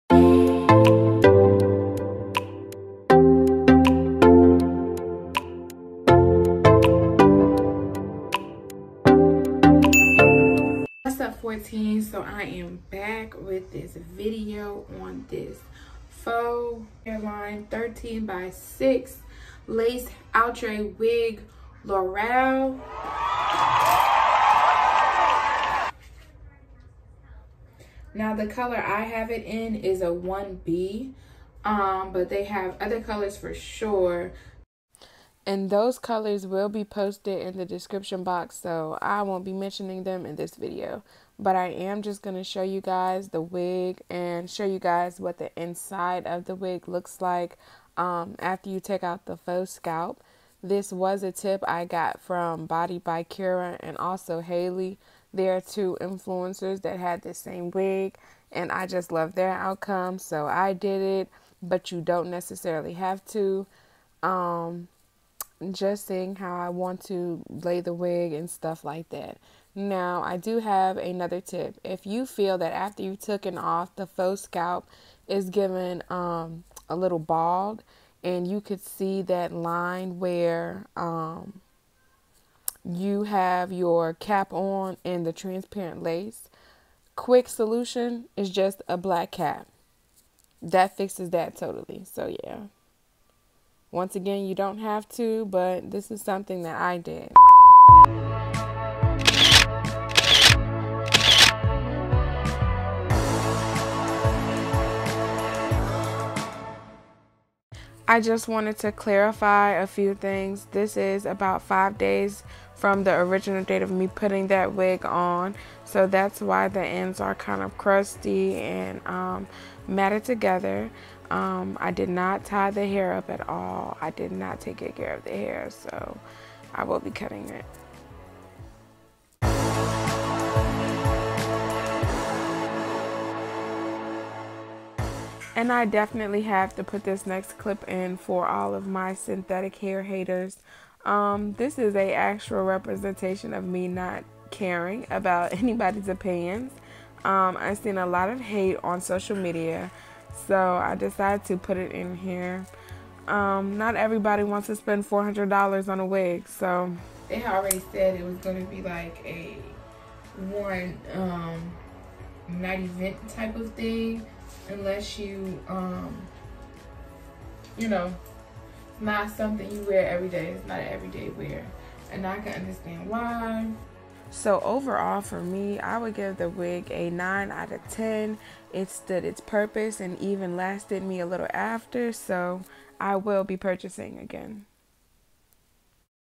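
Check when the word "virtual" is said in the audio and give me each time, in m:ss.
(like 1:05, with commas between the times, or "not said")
not said.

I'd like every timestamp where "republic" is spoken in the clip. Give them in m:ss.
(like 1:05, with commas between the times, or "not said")
not said.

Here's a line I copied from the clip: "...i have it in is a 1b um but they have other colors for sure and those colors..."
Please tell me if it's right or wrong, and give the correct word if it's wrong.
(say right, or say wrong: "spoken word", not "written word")
right.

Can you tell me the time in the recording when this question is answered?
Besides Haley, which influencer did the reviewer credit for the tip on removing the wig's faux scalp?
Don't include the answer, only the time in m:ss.
0:52.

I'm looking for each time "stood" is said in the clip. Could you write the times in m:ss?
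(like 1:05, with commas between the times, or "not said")
2:58.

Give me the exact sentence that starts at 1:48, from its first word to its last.
I just wanted to clarify a few things.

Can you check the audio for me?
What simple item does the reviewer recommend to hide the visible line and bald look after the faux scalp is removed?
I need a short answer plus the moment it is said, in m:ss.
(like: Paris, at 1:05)
black cap, at 1:28.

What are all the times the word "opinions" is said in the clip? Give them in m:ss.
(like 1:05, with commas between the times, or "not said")
2:26.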